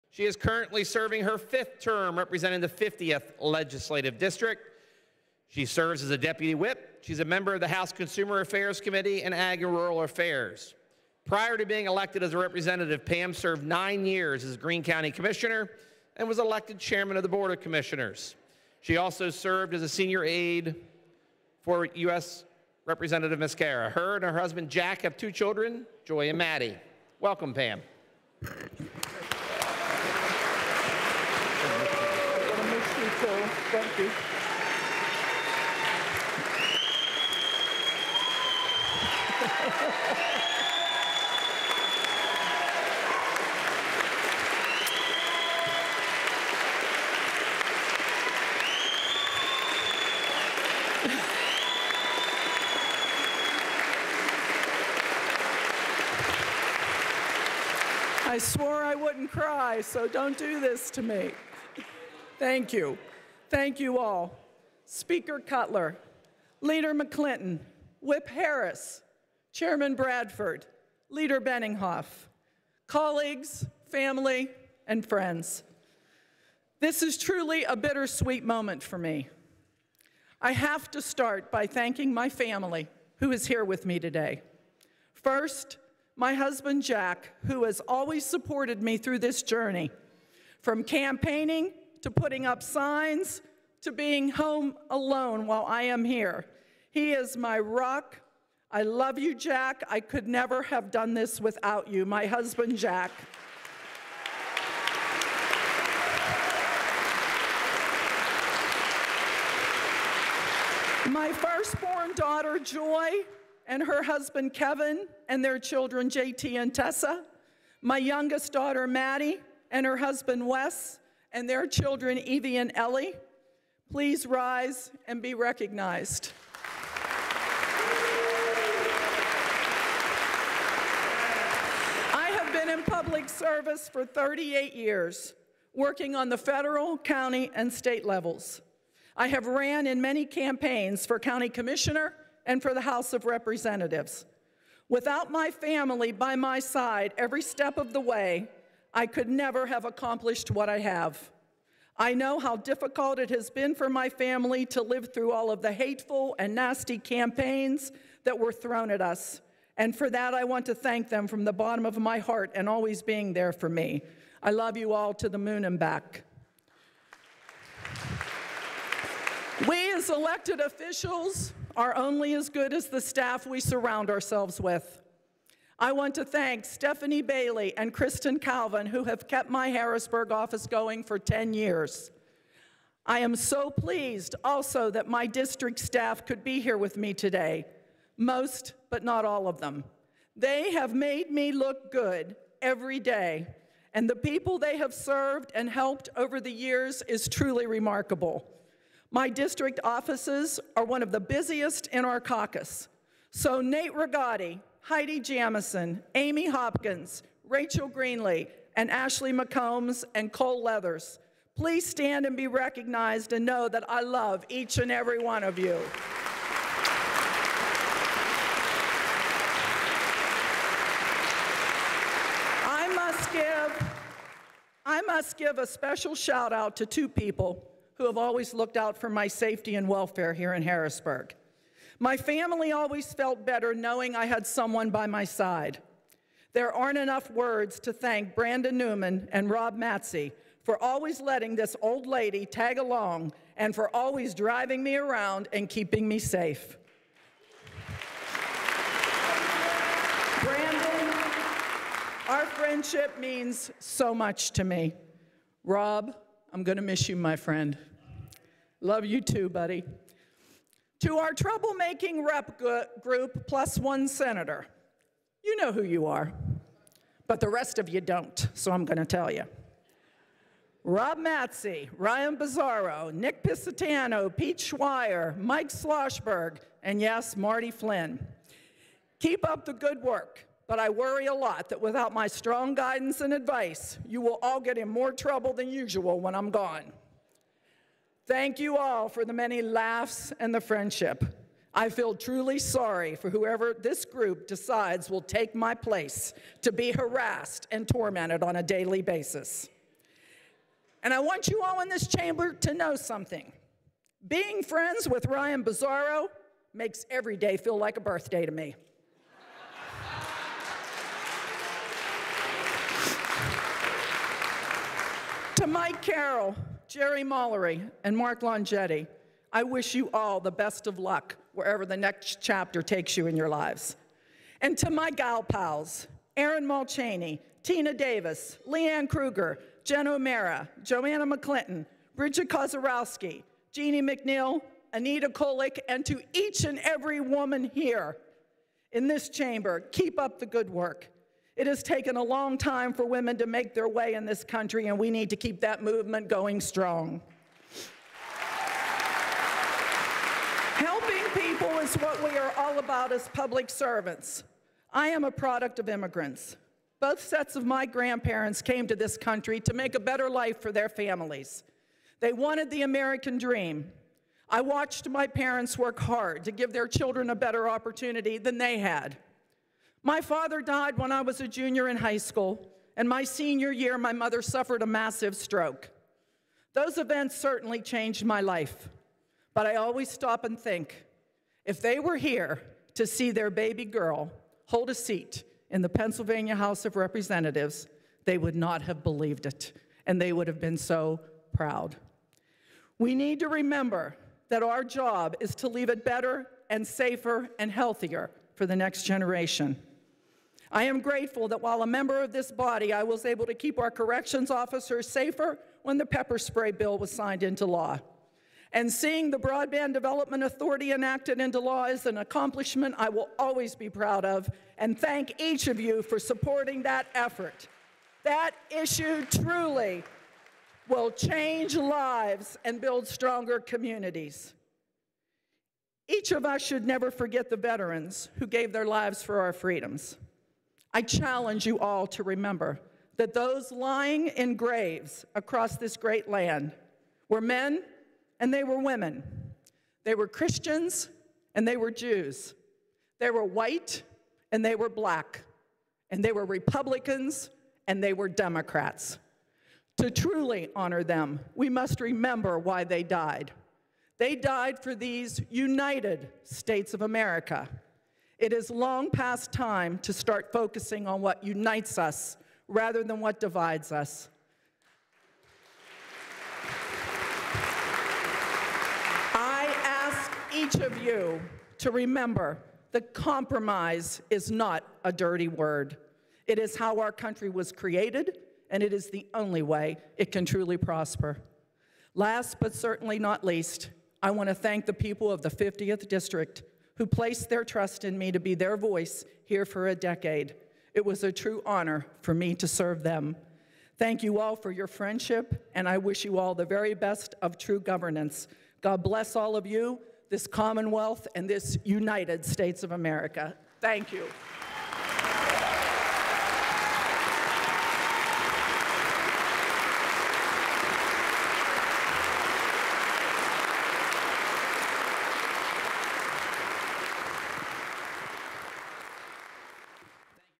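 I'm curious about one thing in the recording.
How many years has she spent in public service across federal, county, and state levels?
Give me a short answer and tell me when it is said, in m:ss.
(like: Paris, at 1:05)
38, at 2:14.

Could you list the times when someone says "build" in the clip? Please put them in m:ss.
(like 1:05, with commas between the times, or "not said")
7:02.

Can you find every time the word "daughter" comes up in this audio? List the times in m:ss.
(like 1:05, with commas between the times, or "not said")
1:52, 1:58.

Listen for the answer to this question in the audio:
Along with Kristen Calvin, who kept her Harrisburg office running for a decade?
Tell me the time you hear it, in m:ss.
2:56.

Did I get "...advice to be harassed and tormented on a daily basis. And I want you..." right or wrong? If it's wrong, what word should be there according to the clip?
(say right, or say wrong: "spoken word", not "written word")
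wrong: "place", not "advice".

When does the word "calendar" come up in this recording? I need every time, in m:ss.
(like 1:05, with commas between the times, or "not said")
not said.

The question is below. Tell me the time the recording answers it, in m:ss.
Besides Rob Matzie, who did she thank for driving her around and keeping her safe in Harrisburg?
3:58.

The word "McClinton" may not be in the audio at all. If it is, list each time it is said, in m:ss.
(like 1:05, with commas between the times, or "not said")
1:06, 5:31.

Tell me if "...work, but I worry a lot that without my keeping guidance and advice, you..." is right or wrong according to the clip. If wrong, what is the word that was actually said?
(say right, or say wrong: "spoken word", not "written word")
wrong: "strong", not "keeping".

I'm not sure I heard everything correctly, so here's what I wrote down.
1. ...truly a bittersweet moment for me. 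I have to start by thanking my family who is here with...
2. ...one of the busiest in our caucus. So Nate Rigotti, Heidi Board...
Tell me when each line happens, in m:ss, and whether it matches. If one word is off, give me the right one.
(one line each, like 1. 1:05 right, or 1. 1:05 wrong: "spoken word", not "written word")
1. 1:17 right
2. 3:20 wrong: "Jamison", not "Board".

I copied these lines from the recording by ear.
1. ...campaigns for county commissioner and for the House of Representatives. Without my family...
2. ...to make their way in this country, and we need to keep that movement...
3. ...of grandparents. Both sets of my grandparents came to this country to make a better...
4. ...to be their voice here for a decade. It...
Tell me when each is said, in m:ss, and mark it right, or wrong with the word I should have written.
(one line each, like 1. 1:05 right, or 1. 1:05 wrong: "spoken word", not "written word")
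1. 2:20 right
2. 5:43 right
3. 5:55 wrong: "immigrants", not "grandparents"
4. 8:08 right.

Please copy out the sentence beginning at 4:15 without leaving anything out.
Rob, I'm going to miss you, my friend.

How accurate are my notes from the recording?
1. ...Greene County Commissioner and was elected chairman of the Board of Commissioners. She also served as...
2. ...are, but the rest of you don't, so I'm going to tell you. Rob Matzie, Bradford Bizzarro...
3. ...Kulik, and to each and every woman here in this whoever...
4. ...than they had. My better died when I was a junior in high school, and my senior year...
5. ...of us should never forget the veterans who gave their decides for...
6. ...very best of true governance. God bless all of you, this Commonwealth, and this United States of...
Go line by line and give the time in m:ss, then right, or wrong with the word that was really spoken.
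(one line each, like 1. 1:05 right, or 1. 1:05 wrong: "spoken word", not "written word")
1. 0:14 right
2. 4:26 wrong: "Ryan", not "Bradford"
3. 5:35 wrong: "chamber", not "whoever"
4. 6:08 wrong: "father", not "better"
5. 7:06 wrong: "lives", not "decides"
6. 8:16 right.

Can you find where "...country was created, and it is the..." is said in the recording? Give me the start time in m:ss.
7:57.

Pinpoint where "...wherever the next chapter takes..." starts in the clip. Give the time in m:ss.
5:21.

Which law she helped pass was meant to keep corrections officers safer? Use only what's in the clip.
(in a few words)
pepper spray bill.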